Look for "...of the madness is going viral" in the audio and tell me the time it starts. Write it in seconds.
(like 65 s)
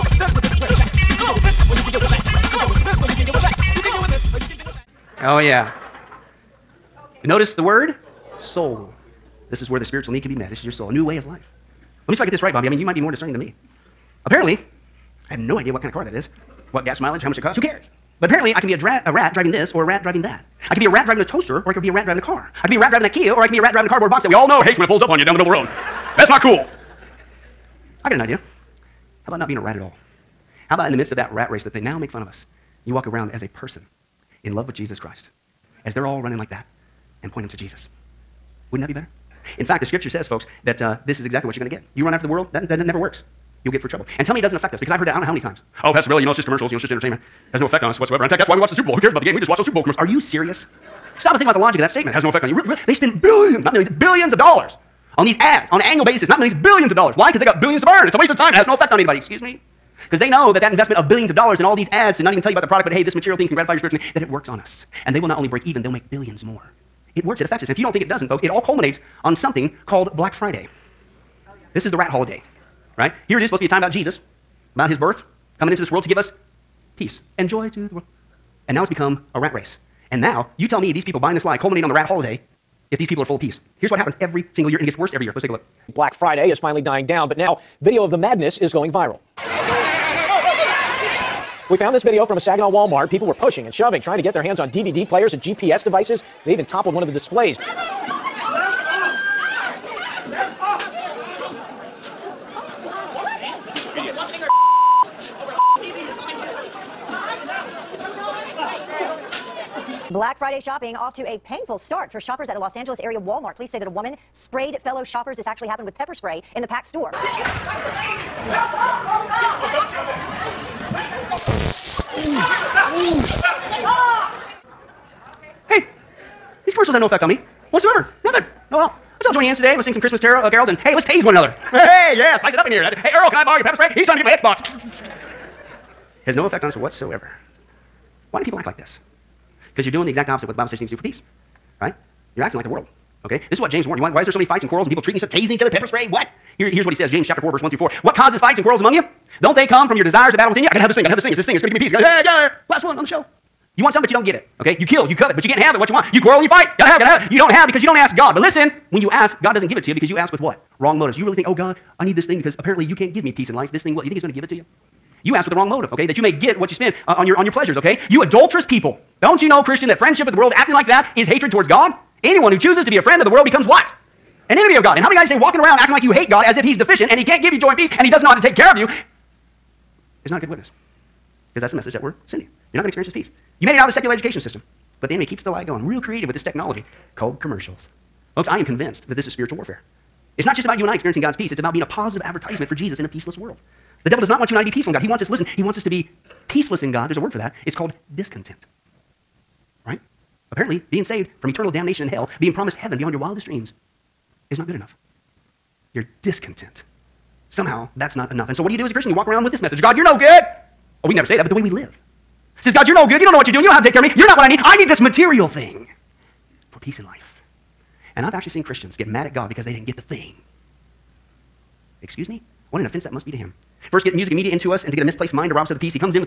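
88 s.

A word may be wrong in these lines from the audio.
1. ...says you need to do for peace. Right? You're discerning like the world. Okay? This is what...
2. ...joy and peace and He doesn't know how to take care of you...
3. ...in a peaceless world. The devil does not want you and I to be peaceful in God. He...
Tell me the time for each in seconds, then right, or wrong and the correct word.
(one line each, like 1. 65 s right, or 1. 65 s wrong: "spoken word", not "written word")
1. 140 s wrong: "acting", not "discerning"
2. 177 s right
3. 192 s right.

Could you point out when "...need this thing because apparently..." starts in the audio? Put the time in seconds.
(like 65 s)
162 s.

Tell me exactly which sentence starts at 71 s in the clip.
This is the rat holiday, right?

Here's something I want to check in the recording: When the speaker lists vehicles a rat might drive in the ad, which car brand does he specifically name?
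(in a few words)
Kia.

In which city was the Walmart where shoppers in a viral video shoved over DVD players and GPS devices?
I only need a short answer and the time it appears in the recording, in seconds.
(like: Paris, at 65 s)
Saginaw, at 92 s.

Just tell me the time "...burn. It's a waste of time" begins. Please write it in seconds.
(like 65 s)
57 s.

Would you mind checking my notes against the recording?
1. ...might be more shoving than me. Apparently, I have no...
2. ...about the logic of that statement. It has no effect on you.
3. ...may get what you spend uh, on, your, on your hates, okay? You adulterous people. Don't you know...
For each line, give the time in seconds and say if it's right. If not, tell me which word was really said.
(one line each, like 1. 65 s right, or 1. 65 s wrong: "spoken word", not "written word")
1. 12 s wrong: "discerning", not "shoving"
2. 51 s right
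3. 166 s wrong: "pleasures", not "hates".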